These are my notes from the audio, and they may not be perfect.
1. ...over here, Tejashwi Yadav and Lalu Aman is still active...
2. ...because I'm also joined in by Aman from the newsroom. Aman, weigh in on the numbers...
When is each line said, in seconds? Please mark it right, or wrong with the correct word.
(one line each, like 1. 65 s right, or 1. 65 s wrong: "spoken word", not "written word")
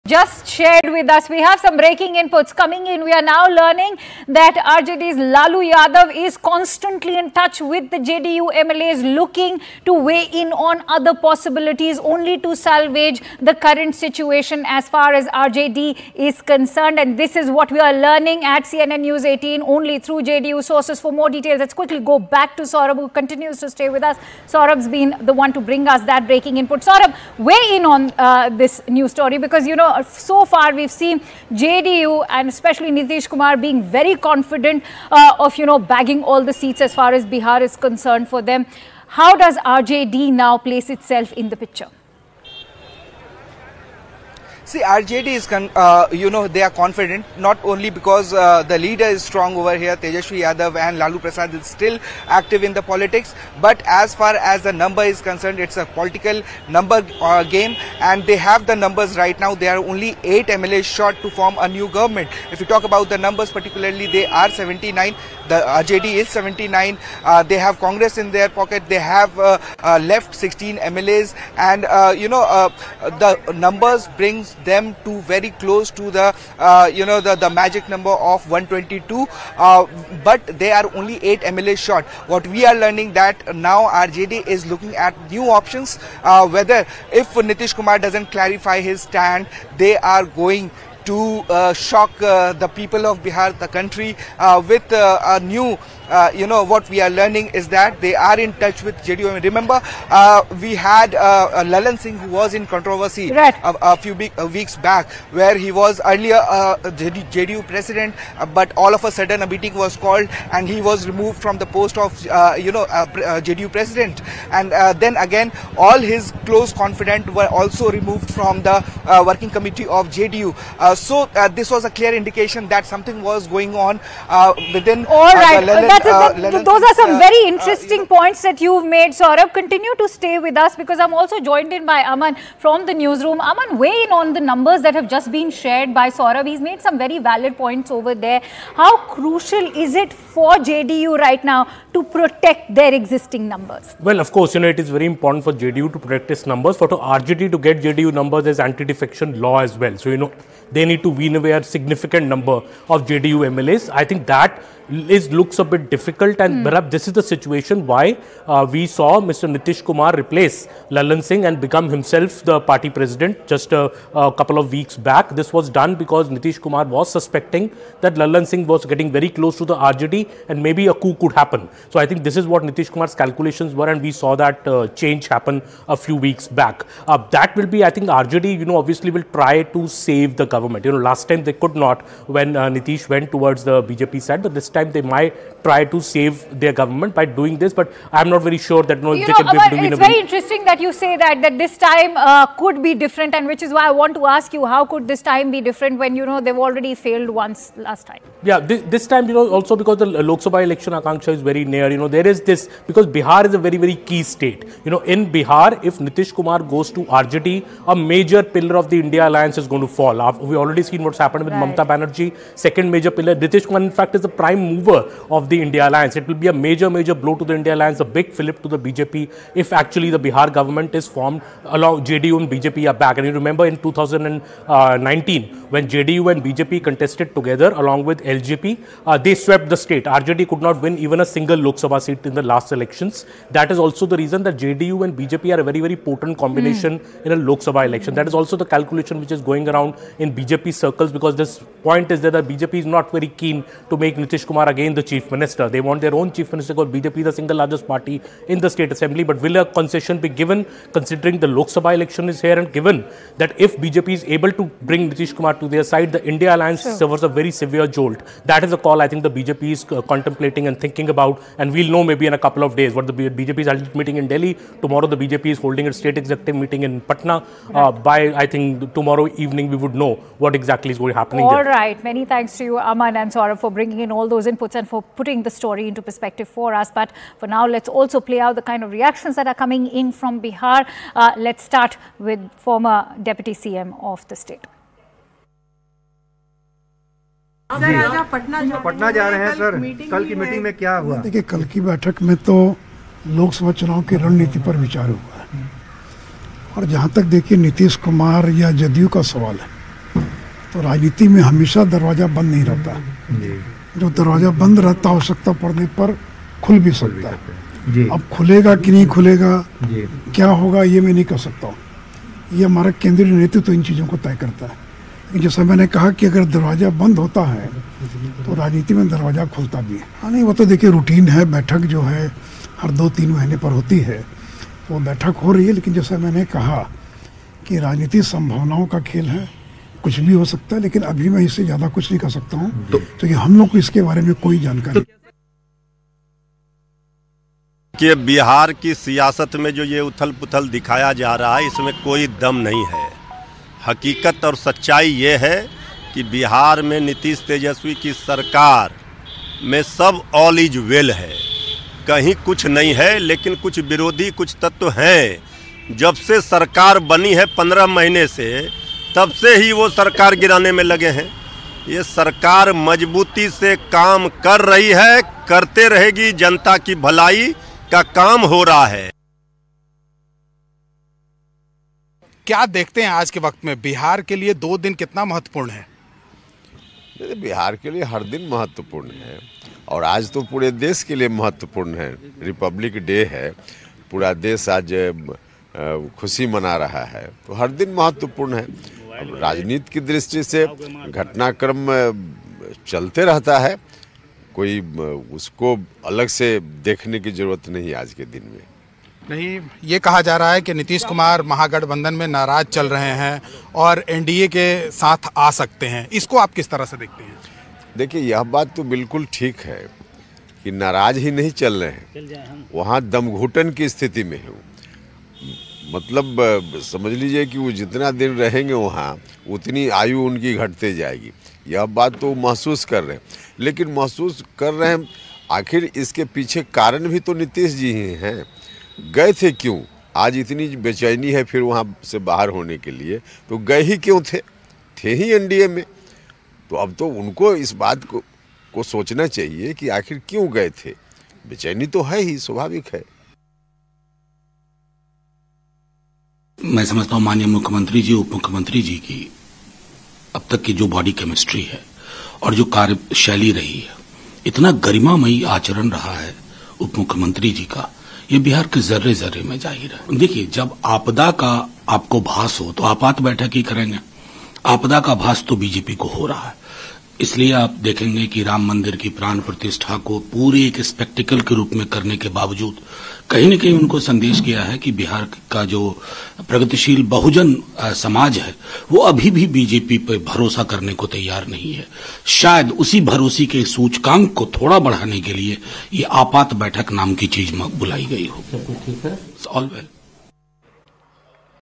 1. 49 s wrong: "Prasad", not "Aman"
2. 130 s right.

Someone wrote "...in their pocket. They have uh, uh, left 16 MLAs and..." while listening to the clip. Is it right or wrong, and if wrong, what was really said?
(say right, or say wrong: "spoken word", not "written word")
right.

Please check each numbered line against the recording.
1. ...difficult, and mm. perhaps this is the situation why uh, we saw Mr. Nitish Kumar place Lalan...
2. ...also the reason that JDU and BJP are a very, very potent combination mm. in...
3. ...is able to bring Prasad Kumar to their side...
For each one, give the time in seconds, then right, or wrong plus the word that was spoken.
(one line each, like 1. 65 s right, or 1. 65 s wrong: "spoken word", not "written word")
1. 155 s wrong: "replace", not "place"
2. 233 s right
3. 254 s wrong: "Nitish", not "Prasad".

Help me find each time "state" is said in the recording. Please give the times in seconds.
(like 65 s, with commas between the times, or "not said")
204 s, 229 s, 248 s, 265 s, 284 s.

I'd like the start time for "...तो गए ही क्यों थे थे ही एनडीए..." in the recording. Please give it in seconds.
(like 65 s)
433 s.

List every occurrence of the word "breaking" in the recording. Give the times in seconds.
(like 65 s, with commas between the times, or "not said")
1 s, 26 s.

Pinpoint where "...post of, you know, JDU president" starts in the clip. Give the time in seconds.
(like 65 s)
111 s.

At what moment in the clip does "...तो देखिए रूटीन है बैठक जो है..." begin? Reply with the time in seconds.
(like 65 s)
320 s.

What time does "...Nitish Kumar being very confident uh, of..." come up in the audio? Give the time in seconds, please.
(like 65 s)
32 s.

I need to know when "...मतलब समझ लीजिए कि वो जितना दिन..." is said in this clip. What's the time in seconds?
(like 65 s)
415 s.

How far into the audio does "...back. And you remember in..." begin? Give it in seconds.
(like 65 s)
223 s.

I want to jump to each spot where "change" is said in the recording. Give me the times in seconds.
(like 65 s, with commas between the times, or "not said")
175 s.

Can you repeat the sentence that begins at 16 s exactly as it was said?
And this is what we are learning at CNN News 18 only through JDU sources.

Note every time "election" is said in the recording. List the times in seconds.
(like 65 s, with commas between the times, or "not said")
200 s, 232 s, 237 s, 251 s.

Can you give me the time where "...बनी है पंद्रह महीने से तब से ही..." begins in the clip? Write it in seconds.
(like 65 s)
357 s.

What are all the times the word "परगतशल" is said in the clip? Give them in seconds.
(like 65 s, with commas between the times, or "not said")
476 s.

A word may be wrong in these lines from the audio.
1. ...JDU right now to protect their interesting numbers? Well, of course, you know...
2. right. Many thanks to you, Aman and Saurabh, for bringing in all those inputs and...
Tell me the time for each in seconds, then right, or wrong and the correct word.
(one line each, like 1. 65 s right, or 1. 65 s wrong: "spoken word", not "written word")
1. 140 s wrong: "existing", not "interesting"
2. 271 s right.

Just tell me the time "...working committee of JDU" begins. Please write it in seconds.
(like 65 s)
119 s.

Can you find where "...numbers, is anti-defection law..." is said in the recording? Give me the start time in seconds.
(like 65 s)
148 s.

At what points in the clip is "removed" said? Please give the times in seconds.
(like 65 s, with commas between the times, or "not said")
111 s, 117 s.